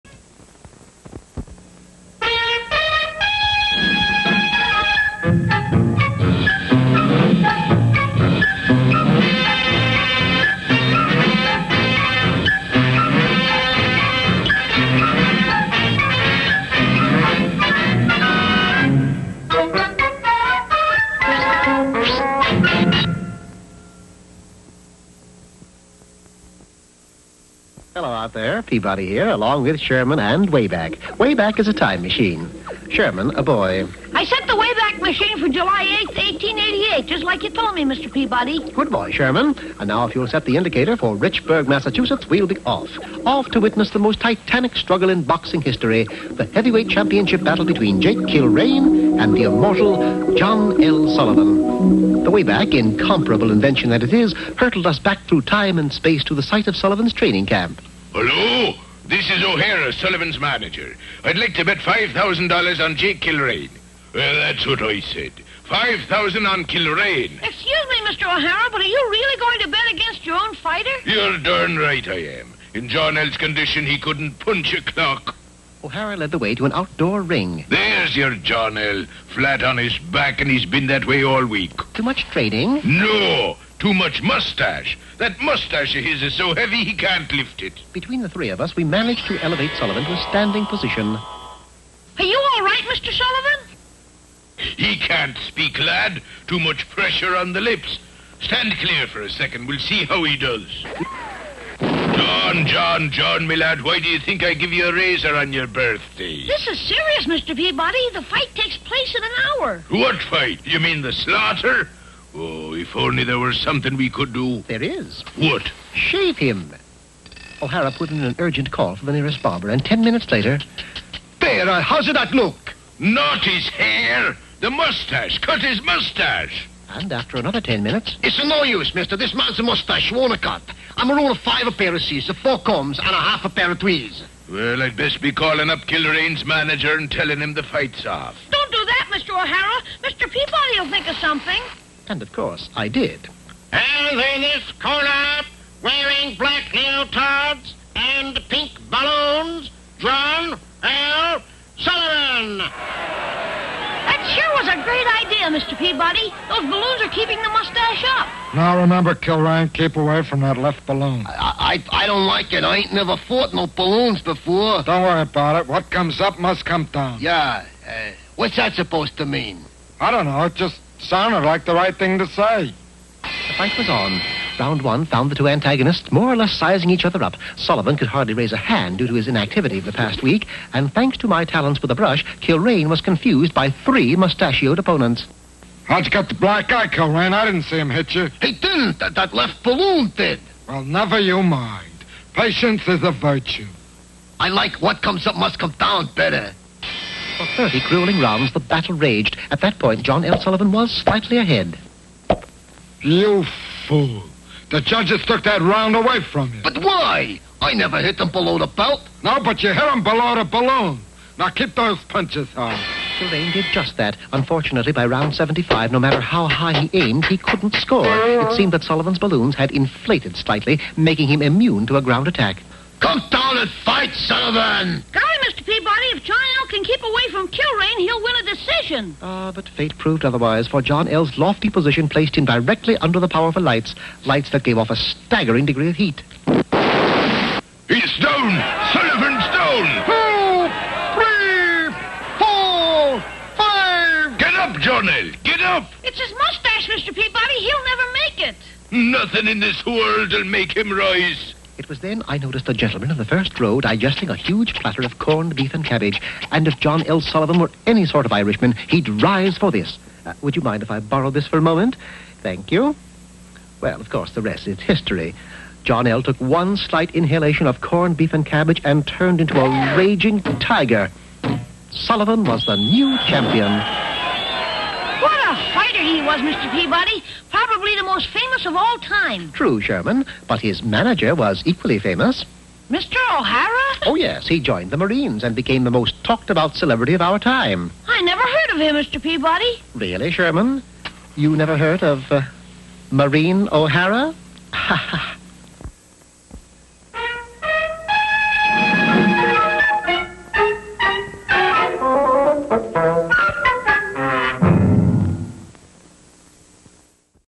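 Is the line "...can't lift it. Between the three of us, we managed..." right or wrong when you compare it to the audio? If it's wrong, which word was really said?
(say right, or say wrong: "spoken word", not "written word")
right.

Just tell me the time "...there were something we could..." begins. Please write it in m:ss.
1:53.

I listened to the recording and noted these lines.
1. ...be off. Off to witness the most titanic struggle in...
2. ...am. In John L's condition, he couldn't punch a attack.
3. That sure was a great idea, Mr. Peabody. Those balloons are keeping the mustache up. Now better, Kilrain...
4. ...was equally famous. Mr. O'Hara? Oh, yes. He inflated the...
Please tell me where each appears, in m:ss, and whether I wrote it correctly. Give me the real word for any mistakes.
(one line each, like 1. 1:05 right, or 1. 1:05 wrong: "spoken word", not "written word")
1. 0:42 right
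2. 1:12 wrong: "clock", not "attack"
3. 2:34 wrong: "remember", not "better"
4. 4:41 wrong: "joined", not "inflated".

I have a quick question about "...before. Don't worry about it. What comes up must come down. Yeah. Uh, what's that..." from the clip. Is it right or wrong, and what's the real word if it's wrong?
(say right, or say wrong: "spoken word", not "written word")
right.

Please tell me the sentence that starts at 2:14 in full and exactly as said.
Well, I'd best be calling up Kilrain's manager and telling him the fight's off.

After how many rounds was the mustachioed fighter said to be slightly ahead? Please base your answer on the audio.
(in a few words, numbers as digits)
30.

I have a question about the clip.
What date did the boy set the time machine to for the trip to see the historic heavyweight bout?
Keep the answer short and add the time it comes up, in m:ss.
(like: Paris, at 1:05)
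July 8th, 1888, at 0:35.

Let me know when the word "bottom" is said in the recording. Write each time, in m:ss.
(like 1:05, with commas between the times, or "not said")
not said.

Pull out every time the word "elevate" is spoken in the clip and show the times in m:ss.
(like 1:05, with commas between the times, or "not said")
1:29.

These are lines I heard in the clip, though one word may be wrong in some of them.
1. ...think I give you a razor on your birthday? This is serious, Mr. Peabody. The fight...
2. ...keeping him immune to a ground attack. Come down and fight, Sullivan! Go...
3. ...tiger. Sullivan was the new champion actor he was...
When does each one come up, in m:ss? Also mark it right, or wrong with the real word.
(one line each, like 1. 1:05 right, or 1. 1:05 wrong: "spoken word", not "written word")
1. 1:44 right
2. 3:40 wrong: "making", not "keeping"
3. 4:30 right.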